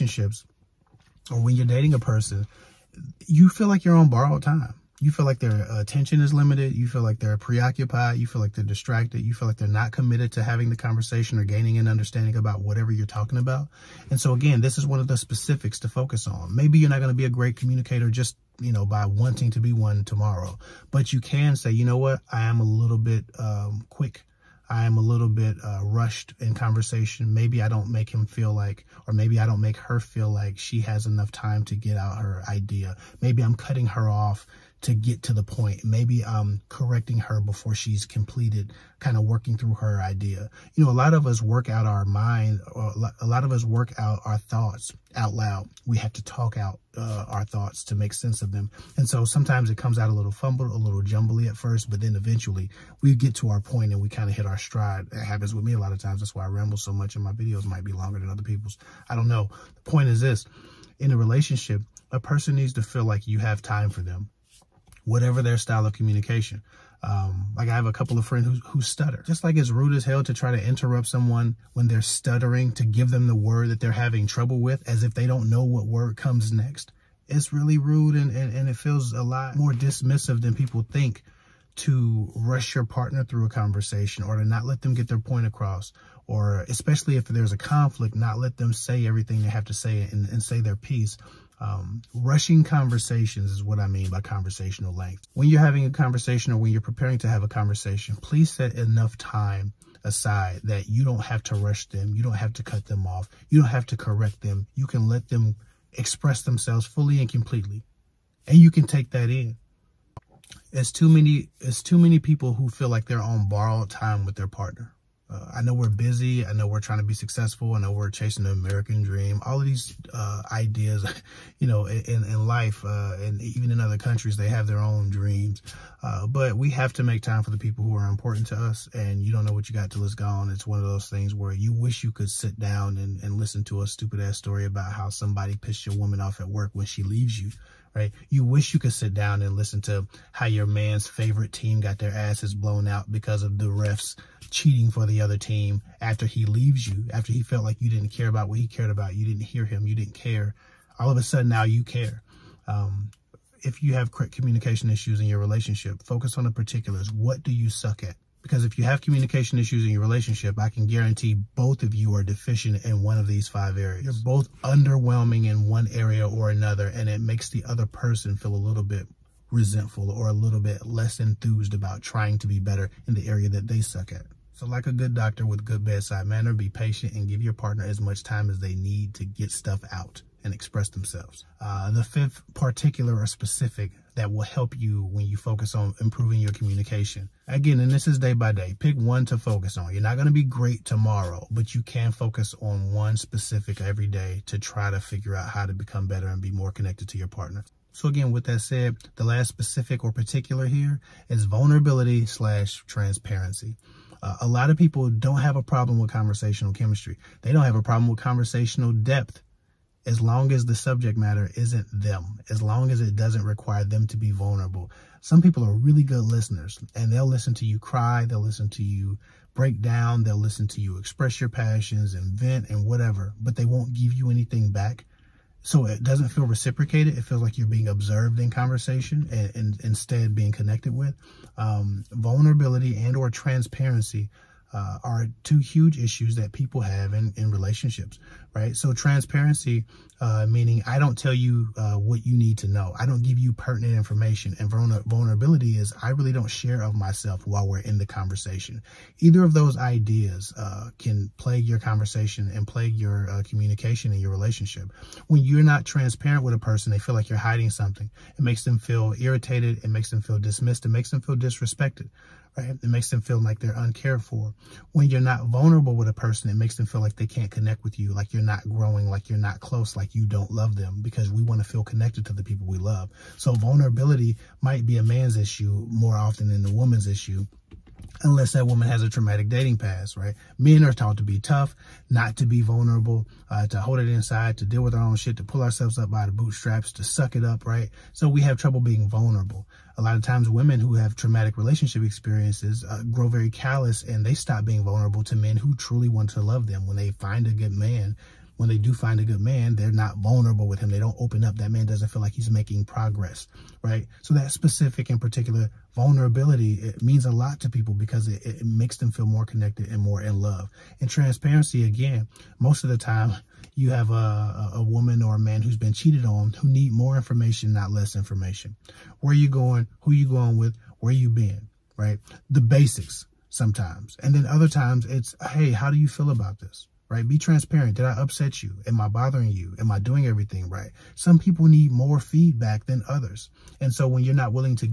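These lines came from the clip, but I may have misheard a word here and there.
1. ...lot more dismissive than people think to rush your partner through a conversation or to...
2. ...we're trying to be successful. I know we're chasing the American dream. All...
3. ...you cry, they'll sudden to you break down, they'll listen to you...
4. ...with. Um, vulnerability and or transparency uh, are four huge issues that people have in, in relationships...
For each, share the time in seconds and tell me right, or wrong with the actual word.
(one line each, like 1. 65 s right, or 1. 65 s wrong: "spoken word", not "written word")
1. 79 s right
2. 116 s right
3. 217 s wrong: "listen", not "sudden"
4. 230 s wrong: "two", not "four".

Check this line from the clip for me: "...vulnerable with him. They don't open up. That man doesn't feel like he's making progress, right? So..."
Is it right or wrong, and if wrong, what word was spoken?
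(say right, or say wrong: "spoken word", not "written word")
right.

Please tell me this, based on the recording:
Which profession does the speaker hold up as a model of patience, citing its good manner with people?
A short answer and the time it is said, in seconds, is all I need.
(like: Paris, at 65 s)
Doctor, at 175 s.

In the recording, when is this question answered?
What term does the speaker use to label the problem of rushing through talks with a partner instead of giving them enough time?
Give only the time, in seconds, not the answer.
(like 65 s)
94 s.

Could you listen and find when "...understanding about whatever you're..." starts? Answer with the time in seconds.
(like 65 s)
11 s.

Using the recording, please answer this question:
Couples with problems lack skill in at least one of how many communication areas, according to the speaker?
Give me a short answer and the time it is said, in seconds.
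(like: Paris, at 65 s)
5, at 163 s.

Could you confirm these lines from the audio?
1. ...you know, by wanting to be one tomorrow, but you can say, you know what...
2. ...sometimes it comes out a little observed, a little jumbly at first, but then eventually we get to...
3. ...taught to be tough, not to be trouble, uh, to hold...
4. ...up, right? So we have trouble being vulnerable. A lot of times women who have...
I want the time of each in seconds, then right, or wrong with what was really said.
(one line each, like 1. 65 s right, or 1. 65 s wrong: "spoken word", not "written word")
1. 18 s right
2. 49 s wrong: "fumbled", not "observed"
3. 280 s wrong: "vulnerable", not "trouble"
4. 287 s right.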